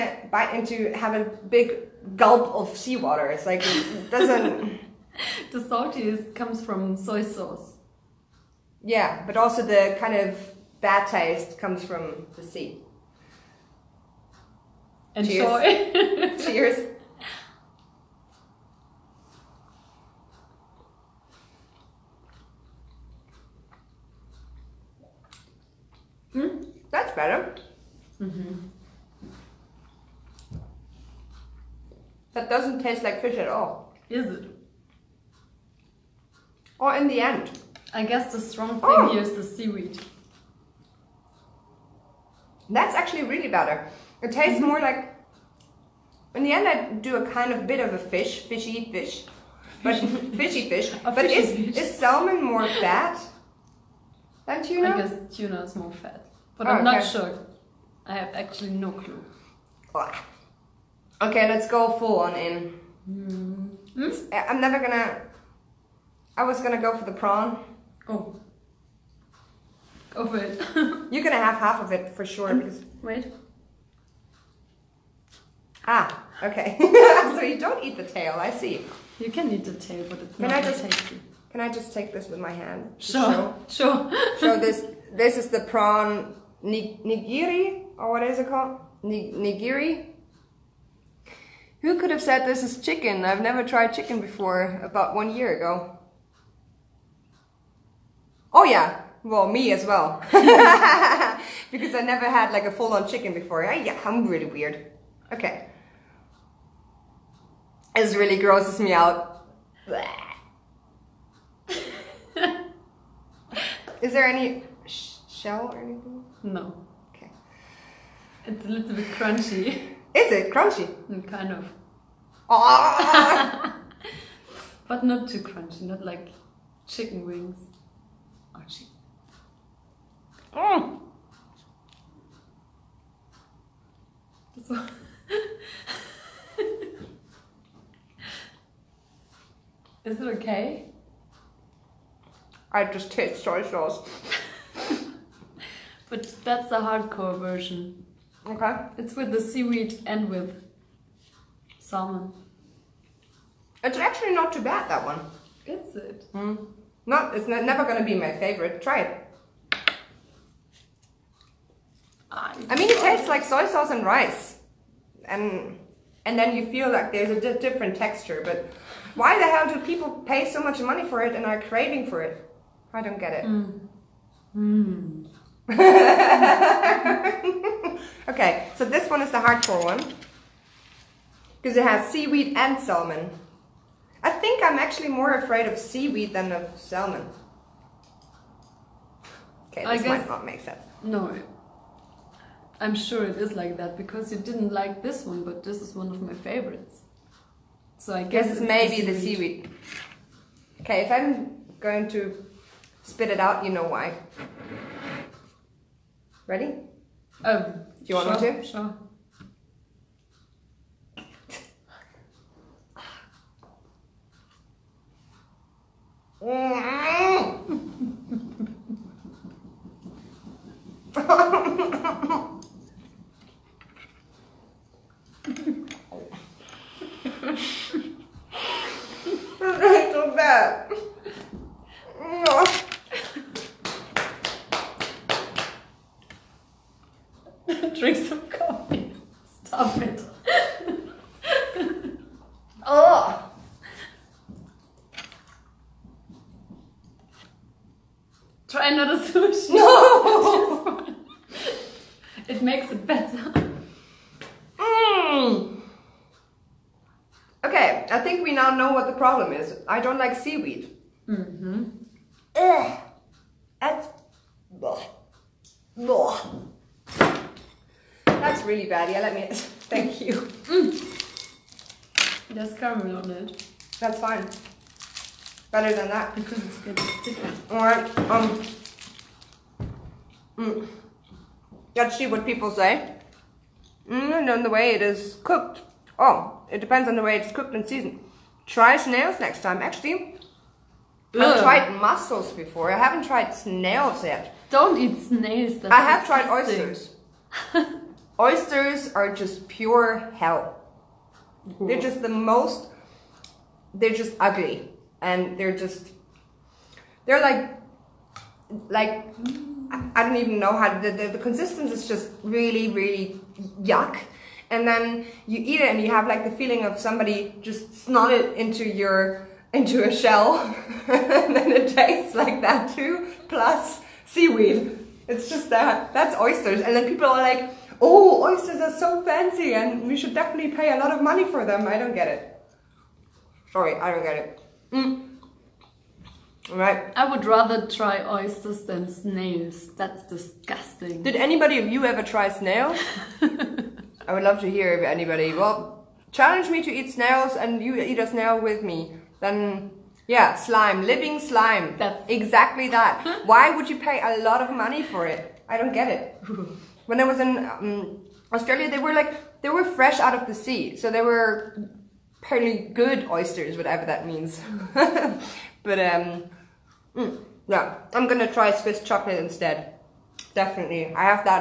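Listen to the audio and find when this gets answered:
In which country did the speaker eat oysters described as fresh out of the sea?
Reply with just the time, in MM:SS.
05:58.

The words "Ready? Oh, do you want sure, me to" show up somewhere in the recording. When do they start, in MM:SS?
03:26.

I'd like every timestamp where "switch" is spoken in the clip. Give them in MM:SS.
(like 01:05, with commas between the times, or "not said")
not said.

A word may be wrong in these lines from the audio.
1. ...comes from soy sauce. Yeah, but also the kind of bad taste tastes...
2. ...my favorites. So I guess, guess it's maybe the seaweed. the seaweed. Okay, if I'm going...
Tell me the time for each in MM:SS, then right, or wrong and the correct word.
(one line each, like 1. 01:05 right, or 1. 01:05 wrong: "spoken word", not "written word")
1. 00:06 wrong: "comes", not "tastes"
2. 03:16 right.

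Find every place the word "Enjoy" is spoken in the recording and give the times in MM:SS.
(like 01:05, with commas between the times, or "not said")
00:15.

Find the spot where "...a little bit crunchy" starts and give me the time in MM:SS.
01:58.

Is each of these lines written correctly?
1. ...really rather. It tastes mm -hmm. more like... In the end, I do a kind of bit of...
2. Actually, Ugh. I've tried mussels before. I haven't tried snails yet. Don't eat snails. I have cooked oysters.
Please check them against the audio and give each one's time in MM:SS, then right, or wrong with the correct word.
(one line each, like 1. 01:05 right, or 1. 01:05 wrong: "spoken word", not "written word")
1. 00:43 wrong: "better", not "rather"
2. 04:49 wrong: "tried", not "cooked".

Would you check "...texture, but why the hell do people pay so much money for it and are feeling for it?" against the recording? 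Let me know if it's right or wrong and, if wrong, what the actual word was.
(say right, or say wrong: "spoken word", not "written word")
wrong: "craving", not "feeling".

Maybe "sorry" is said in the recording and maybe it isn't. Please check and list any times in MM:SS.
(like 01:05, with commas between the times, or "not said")
05:33.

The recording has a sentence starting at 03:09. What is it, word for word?
Okay, this guess, might not make sense.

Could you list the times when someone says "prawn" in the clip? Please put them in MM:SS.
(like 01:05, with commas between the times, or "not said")
01:07, 01:25.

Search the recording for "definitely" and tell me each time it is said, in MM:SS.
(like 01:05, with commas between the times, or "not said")
05:30, 06:10.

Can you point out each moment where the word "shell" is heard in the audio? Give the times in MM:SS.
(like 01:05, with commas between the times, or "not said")
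01:55, 05:20.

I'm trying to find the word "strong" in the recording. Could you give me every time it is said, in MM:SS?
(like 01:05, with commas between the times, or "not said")
00:38.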